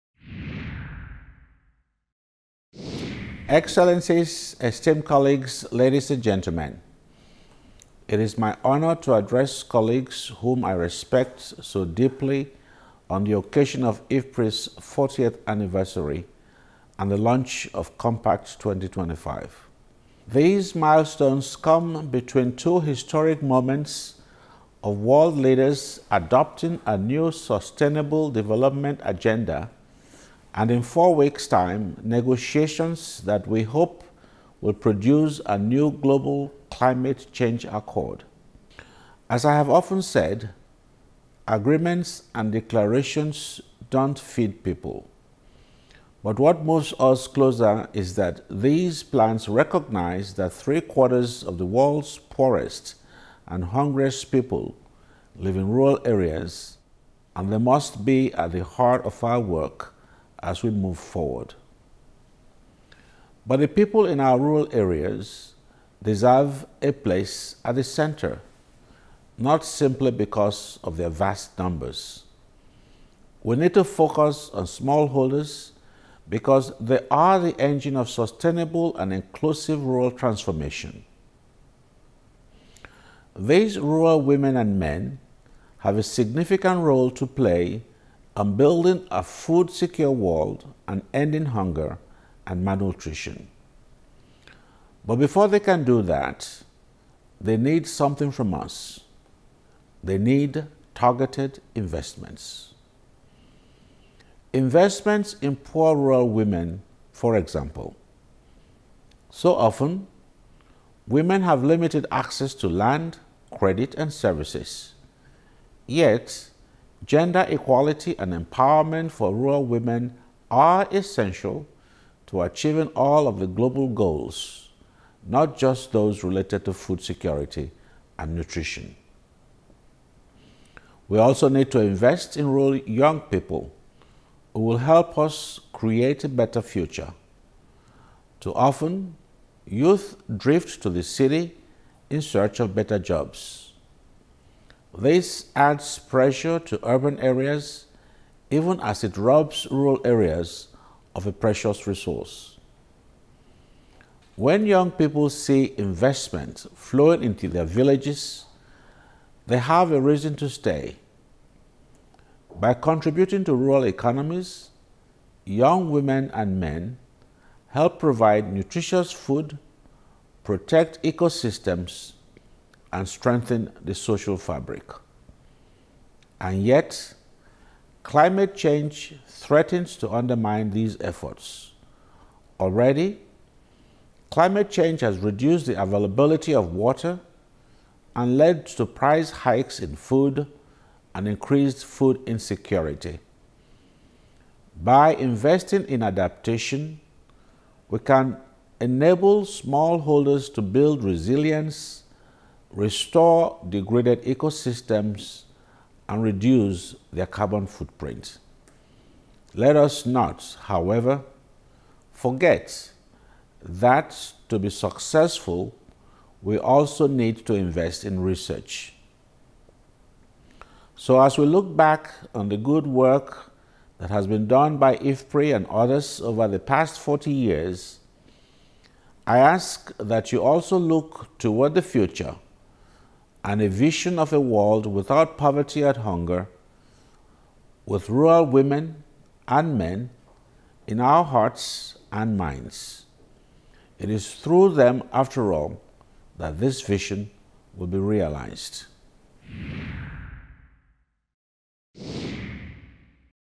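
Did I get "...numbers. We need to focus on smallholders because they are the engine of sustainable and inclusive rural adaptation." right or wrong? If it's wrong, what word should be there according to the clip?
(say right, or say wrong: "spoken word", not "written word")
wrong: "transformation", not "adaptation".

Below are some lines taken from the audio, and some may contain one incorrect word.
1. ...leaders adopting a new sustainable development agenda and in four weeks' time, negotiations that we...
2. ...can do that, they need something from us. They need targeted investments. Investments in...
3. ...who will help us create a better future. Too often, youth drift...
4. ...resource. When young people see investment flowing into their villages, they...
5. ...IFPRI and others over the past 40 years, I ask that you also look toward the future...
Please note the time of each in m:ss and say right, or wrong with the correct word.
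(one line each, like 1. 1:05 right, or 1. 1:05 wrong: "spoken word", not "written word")
1. 0:25 right
2. 1:35 right
3. 2:14 right
4. 2:31 right
5. 3:44 right.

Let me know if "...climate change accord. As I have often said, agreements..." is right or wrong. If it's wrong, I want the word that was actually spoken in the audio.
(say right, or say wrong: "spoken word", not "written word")
right.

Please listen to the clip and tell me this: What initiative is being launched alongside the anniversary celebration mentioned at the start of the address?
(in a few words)
Compact 2025.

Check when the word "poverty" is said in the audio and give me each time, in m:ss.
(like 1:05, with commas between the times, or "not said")
3:55.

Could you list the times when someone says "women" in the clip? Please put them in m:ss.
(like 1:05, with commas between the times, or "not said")
1:24, 1:46, 1:51, 1:59, 2:45, 3:58.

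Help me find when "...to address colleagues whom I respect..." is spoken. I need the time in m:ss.
0:08.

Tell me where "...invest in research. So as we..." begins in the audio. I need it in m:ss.
3:37.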